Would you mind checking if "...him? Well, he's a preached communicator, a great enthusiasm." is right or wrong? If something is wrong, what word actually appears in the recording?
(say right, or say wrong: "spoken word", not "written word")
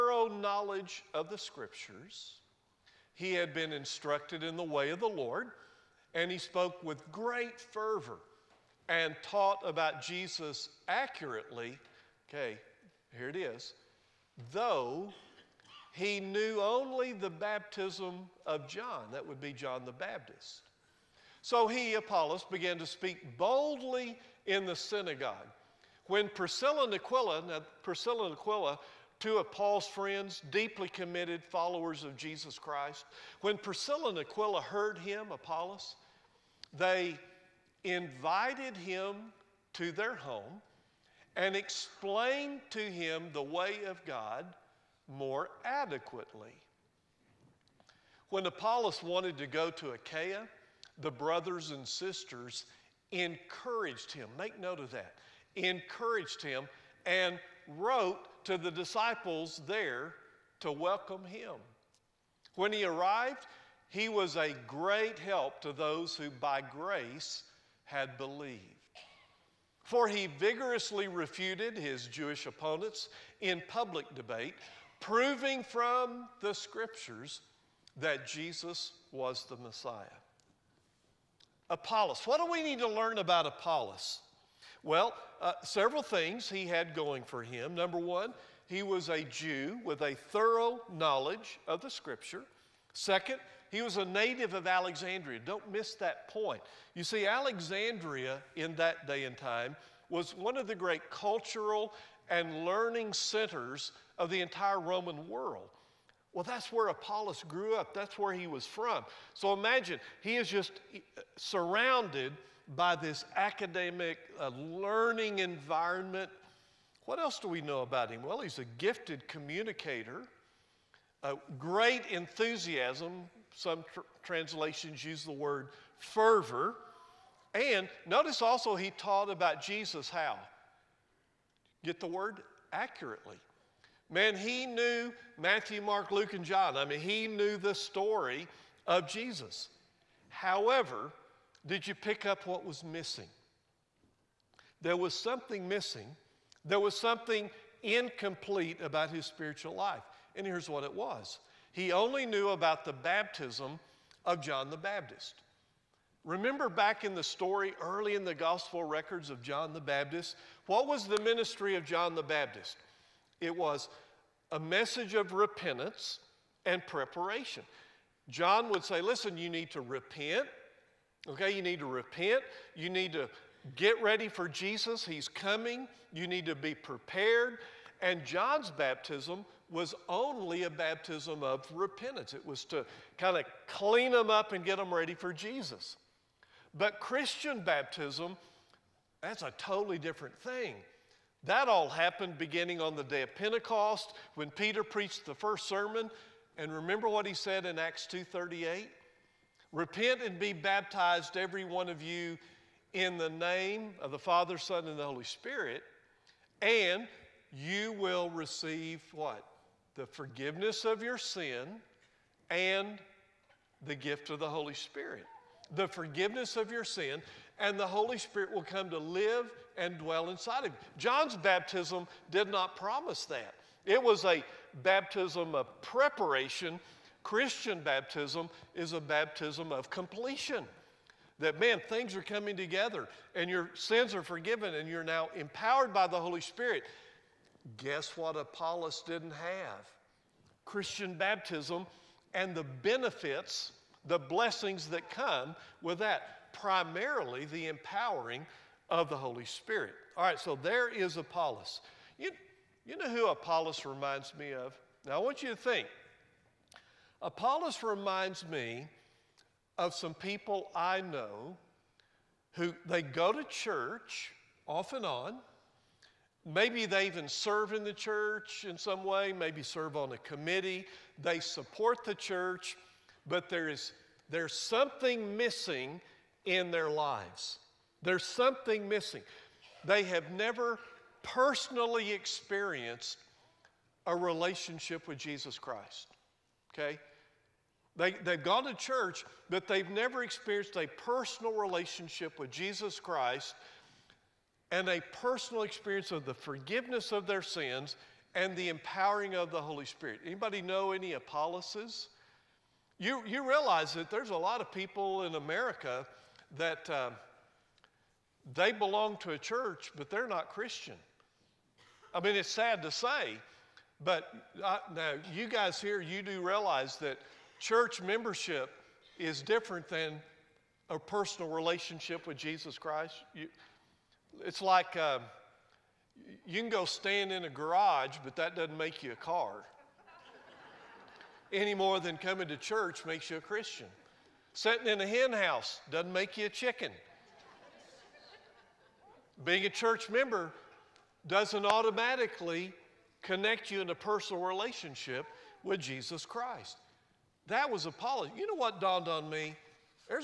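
wrong: "gifted", not "preached".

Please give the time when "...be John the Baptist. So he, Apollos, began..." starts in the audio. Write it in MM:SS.
00:19.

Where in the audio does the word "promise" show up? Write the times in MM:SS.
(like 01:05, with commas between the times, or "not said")
03:42.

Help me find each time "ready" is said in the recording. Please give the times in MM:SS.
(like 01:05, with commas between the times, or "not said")
02:54, 03:04.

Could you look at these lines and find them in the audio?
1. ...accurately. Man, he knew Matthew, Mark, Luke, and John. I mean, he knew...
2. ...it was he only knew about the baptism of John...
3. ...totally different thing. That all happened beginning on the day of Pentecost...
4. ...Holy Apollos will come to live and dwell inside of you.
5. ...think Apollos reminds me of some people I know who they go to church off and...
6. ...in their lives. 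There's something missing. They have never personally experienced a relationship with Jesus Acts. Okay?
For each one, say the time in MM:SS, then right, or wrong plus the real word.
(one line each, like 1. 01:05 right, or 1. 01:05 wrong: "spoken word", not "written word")
1. 02:12 right
2. 02:30 right
3. 03:09 right
4. 03:37 wrong: "Spirit", not "Apollos"
5. 04:15 right
6. 04:36 wrong: "Christ", not "Acts".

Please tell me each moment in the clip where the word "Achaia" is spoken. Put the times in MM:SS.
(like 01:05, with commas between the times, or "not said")
00:49.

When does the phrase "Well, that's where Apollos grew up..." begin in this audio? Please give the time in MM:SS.
01:46.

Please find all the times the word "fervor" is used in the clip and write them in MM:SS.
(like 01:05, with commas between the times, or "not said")
00:07, 02:05.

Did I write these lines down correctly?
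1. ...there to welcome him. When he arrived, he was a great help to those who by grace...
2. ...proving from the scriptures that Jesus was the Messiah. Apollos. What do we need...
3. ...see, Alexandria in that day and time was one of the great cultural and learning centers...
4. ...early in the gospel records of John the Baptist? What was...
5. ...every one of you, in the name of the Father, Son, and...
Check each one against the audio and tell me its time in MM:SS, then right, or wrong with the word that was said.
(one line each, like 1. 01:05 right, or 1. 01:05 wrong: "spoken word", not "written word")
1. 00:59 right
2. 01:14 right
3. 01:37 right
4. 02:37 right
5. 03:21 right.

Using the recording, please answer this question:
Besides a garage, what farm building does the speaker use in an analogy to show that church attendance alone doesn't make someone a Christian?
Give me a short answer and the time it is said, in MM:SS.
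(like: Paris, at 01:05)
hen house, at 05:35.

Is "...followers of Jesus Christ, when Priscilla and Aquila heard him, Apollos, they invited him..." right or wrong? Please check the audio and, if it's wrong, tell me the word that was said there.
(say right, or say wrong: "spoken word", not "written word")
right.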